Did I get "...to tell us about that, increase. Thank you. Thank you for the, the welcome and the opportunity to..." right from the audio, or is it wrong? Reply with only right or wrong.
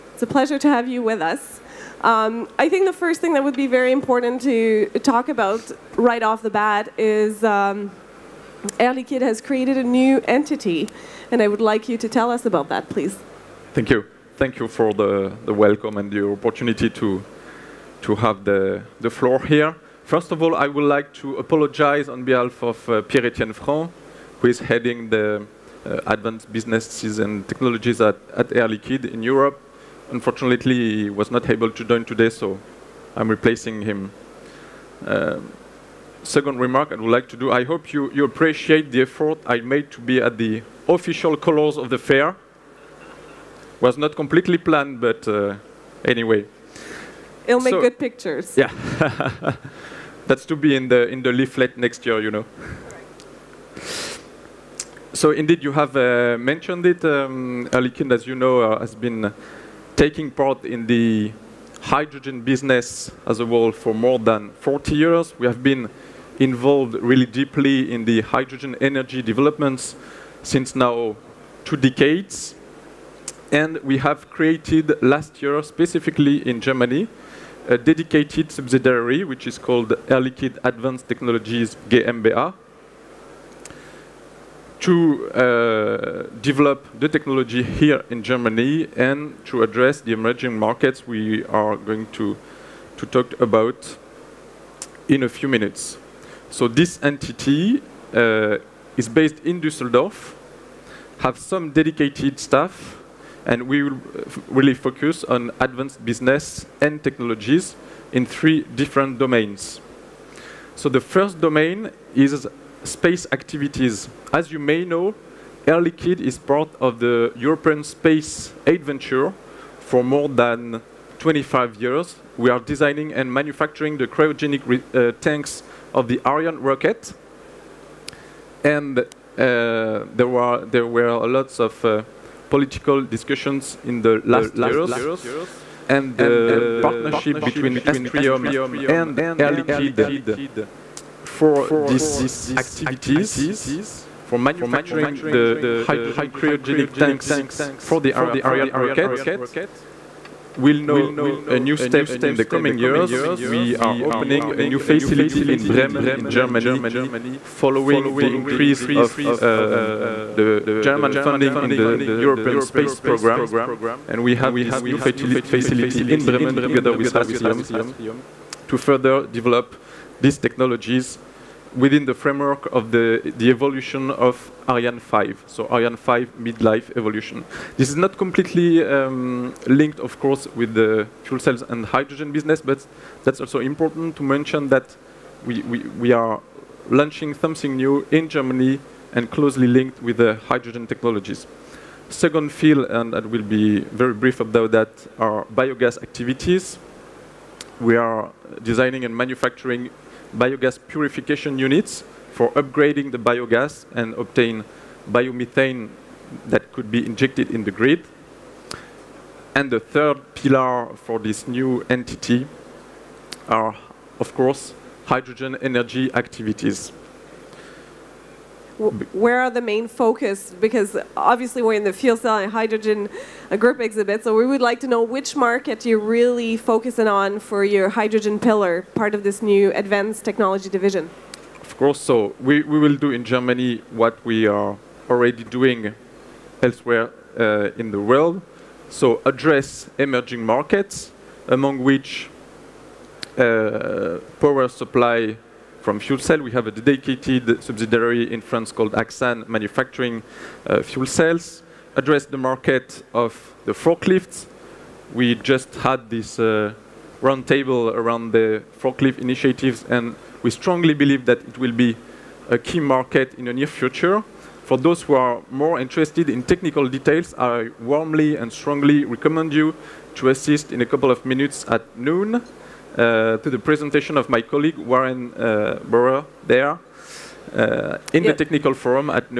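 wrong.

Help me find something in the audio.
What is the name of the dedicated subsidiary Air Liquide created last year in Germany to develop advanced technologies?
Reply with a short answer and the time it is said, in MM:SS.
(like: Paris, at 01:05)
Air Advanced Technologies GmbH, at 01:20.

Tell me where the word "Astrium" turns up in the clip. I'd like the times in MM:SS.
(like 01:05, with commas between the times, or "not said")
02:17, 02:47.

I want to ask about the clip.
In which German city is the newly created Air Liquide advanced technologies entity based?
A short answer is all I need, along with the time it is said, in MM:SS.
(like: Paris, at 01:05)
Düsseldorf, at 01:39.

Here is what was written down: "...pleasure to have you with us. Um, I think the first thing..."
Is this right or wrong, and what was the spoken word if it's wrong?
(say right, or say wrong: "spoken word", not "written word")
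right.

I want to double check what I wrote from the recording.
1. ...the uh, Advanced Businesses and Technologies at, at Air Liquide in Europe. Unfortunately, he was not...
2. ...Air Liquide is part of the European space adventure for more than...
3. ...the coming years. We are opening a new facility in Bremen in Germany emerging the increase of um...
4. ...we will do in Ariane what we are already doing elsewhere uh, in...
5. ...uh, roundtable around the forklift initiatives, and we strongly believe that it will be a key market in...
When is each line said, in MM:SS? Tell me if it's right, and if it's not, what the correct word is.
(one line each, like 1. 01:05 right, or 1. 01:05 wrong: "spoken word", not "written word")
1. 00:25 right
2. 01:55 right
3. 02:32 wrong: "following", not "emerging"
4. 03:52 wrong: "Germany", not "Ariane"
5. 04:16 right.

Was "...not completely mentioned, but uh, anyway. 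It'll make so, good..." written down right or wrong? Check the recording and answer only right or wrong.
wrong.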